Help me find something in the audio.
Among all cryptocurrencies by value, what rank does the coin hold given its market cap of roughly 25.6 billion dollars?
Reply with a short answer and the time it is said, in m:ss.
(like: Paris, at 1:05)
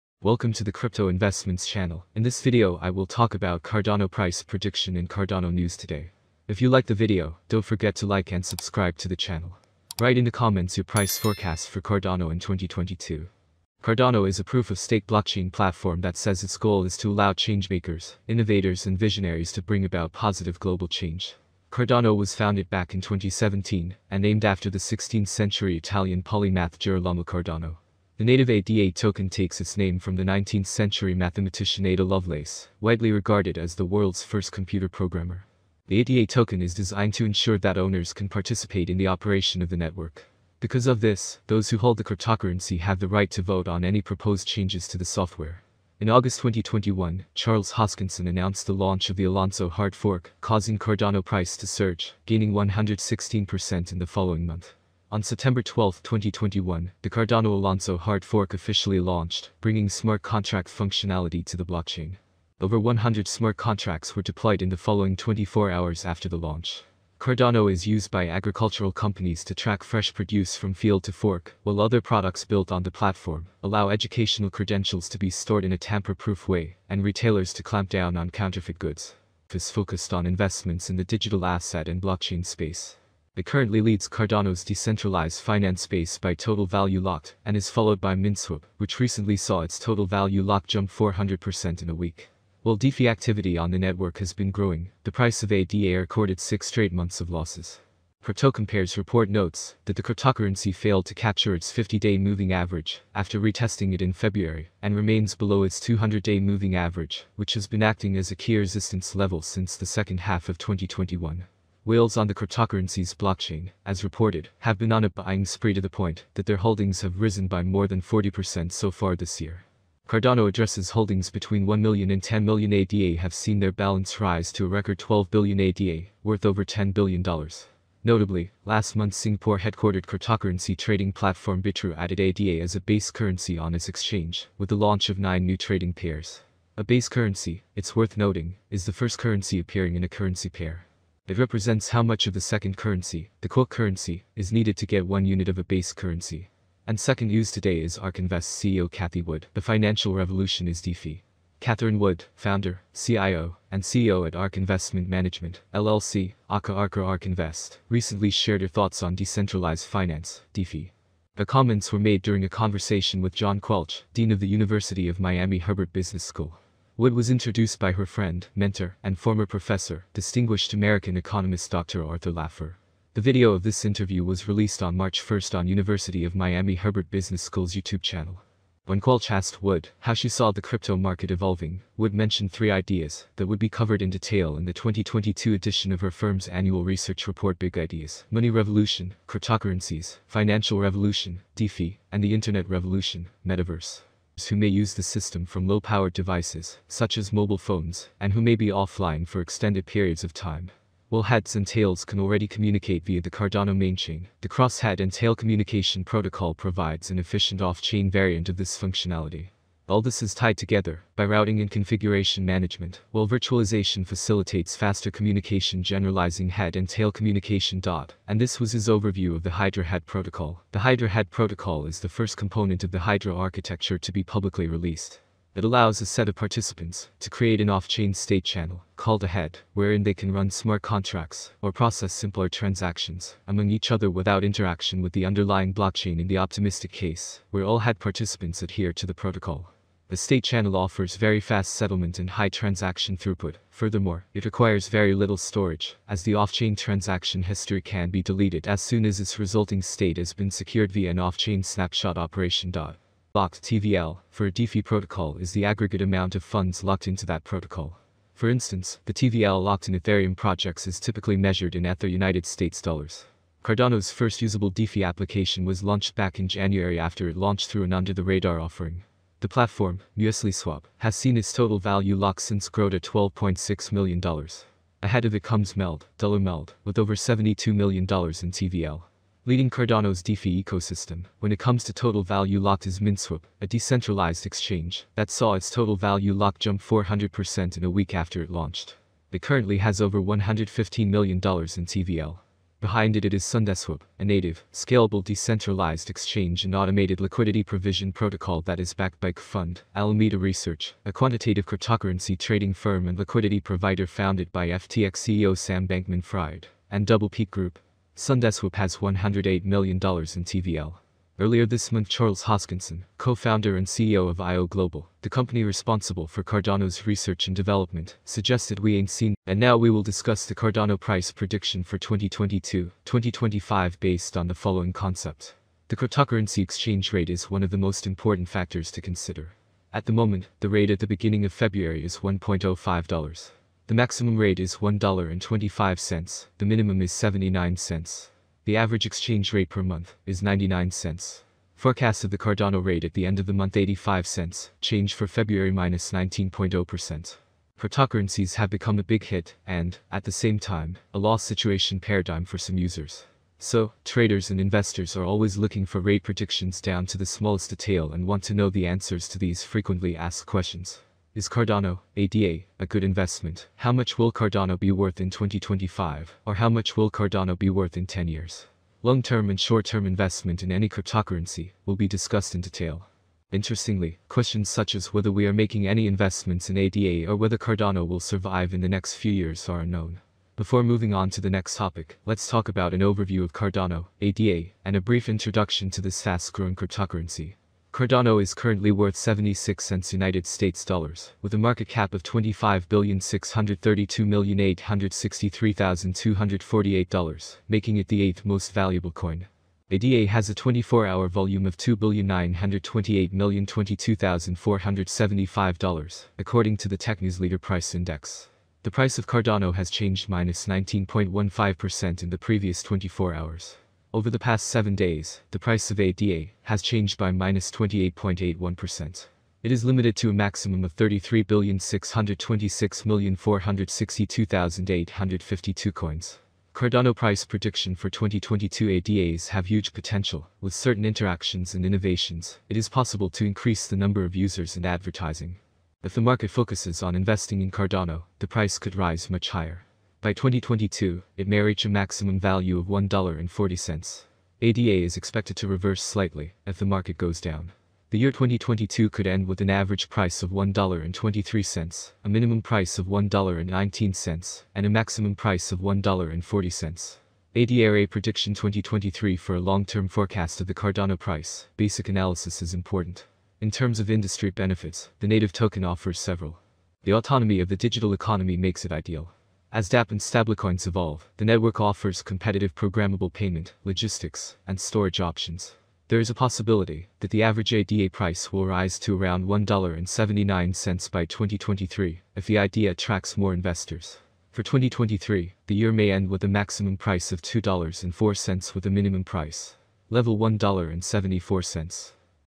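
eighth, at 6:38.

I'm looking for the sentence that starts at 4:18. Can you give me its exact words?
For instance, the TVL locked in Ethereum projects is typically measured in Ether United States dollars.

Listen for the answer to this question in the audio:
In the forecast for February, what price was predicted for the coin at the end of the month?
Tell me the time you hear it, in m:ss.
5:43.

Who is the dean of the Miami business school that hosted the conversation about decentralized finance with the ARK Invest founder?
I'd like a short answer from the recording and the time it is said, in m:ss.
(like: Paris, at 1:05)
John Quelch, at 2:43.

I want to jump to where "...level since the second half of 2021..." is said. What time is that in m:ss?
1:49.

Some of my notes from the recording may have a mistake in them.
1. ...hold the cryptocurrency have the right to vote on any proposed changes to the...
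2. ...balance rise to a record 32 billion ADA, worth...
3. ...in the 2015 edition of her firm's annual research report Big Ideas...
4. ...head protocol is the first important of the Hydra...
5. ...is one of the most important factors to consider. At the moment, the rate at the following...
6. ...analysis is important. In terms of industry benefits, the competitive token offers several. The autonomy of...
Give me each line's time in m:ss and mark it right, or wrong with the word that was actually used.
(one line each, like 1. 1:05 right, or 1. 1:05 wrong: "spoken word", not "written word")
1. 0:41 right
2. 2:03 wrong: "12", not "32"
3. 3:04 wrong: "2022", not "2015"
4. 3:41 wrong: "component", not "important"
5. 5:27 wrong: "beginning", not "following"
6. 7:42 wrong: "native", not "competitive".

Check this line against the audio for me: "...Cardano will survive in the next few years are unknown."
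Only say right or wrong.
right.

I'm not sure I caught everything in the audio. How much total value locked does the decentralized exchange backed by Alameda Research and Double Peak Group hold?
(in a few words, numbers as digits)
$108 million.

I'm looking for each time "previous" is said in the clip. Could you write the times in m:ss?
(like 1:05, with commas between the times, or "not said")
6:52.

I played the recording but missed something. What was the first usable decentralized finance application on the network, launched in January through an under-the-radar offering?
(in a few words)
MuesliSwap.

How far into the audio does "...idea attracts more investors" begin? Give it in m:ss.
8:02.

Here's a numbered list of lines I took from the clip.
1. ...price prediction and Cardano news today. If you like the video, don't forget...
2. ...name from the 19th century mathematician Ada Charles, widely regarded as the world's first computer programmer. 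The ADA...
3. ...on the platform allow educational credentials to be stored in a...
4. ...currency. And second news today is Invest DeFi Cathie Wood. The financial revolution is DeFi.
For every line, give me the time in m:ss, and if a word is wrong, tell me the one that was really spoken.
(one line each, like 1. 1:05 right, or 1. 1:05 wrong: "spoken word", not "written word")
1. 0:04 right
2. 0:29 wrong: "Lovelace", not "Charles"
3. 1:12 right
4. 2:25 wrong: "CEO", not "DeFi".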